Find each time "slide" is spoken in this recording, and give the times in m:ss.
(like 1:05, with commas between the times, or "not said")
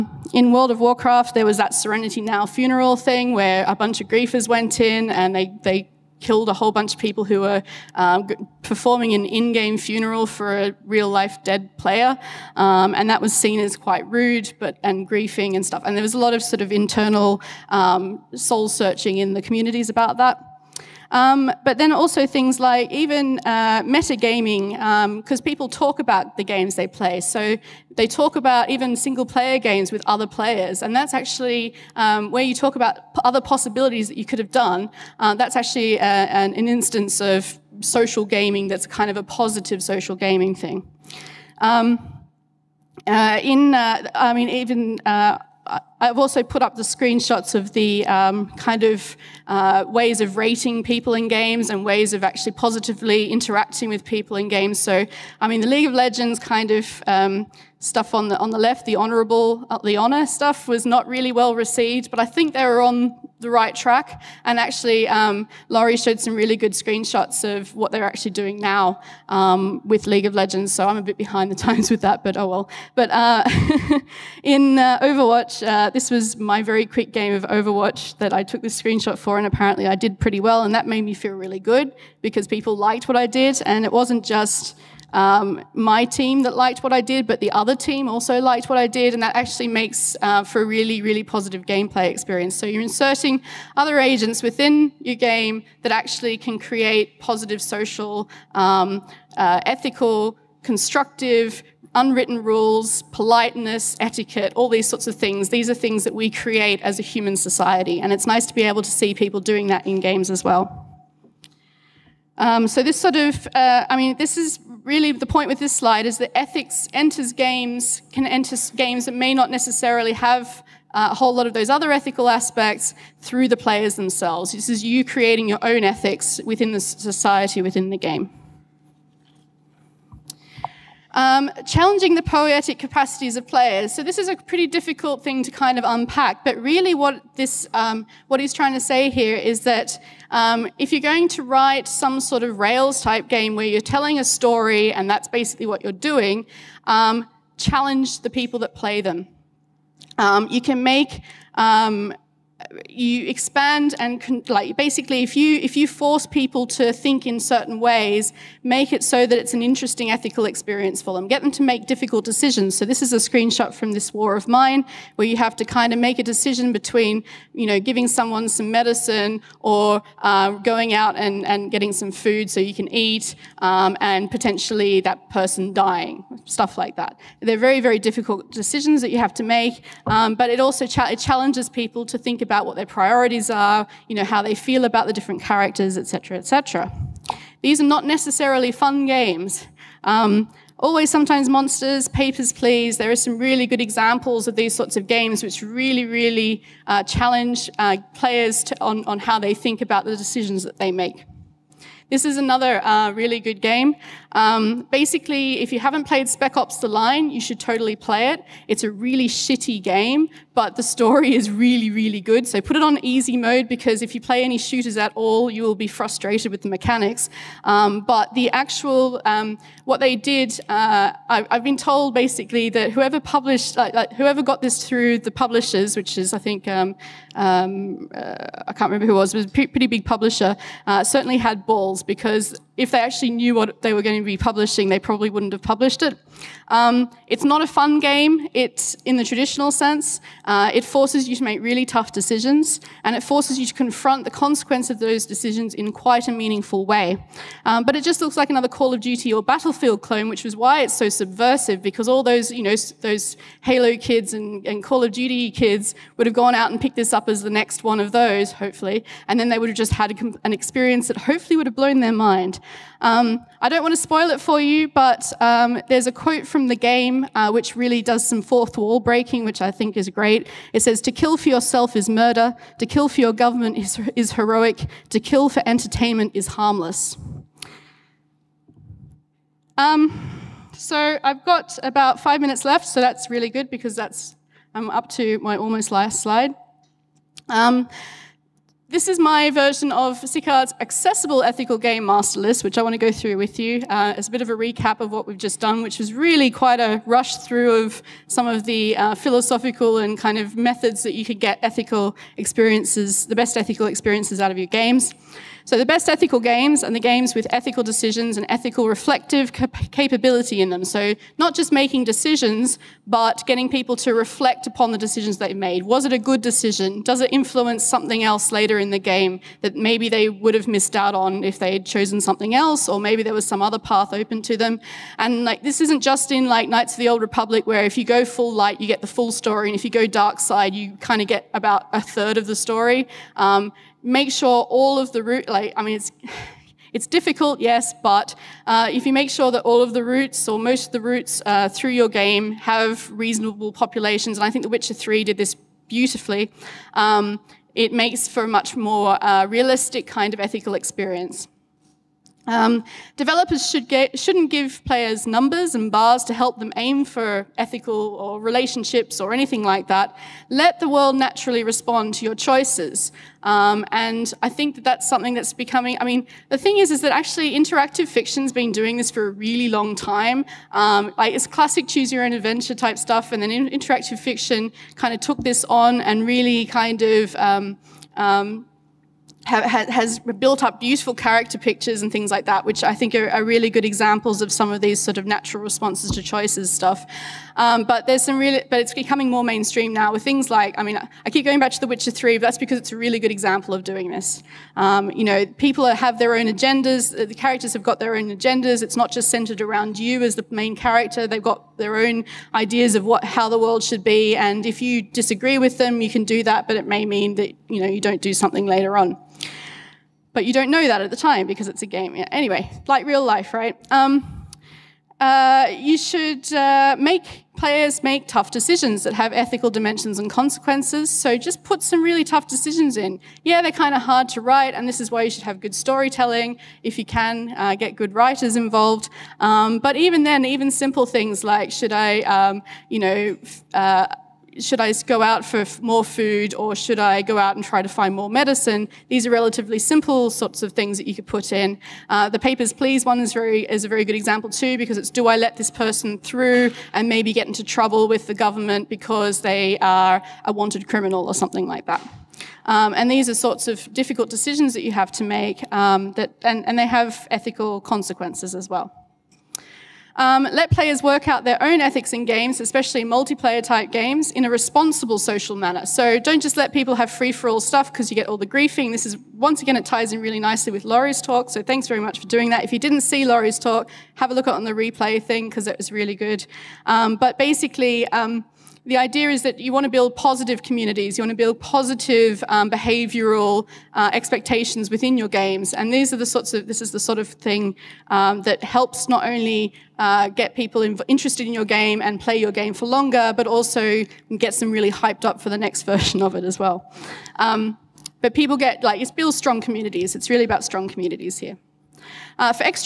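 1:55, 4:46.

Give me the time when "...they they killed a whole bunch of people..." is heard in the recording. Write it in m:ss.
0:05.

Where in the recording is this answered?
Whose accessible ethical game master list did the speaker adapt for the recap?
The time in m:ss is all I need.
4:50.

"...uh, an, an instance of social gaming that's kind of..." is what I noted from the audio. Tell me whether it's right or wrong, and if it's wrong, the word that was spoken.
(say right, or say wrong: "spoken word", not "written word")
right.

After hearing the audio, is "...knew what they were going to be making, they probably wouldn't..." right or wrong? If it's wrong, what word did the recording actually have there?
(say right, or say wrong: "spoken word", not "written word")
wrong: "publishing", not "making".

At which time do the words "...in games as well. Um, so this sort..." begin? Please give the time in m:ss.
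1:49.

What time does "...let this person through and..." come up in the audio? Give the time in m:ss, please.
7:25.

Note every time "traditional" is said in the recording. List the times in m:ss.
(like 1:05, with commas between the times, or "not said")
3:59.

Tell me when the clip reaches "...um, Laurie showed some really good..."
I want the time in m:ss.
1:05.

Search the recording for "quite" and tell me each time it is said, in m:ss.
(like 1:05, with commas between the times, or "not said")
0:13, 4:05, 4:56.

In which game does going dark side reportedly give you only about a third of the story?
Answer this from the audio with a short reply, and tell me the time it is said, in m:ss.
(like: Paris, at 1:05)
Knights of the Old Republic, at 5:26.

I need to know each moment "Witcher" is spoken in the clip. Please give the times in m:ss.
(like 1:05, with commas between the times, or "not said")
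5:44, 6:31.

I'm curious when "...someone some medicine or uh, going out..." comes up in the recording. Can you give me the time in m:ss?
2:48.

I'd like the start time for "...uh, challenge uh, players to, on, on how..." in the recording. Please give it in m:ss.
3:16.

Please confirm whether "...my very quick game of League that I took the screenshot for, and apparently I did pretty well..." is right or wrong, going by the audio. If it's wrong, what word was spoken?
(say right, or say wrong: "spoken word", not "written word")
wrong: "Overwatch", not "League".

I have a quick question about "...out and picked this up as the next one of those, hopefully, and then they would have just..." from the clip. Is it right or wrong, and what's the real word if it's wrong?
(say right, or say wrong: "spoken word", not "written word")
right.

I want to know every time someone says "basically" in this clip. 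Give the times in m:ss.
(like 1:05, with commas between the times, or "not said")
2:25, 2:34, 3:24, 3:42, 7:57.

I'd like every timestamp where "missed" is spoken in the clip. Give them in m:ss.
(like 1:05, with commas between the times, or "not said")
5:20.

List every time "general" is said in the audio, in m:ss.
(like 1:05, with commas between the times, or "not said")
not said.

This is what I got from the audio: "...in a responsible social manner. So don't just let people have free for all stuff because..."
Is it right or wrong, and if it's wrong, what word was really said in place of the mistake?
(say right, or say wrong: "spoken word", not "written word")
right.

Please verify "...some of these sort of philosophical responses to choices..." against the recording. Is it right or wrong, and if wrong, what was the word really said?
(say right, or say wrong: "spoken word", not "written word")
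wrong: "natural", not "philosophical".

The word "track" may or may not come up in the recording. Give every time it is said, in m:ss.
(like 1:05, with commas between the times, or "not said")
1:03.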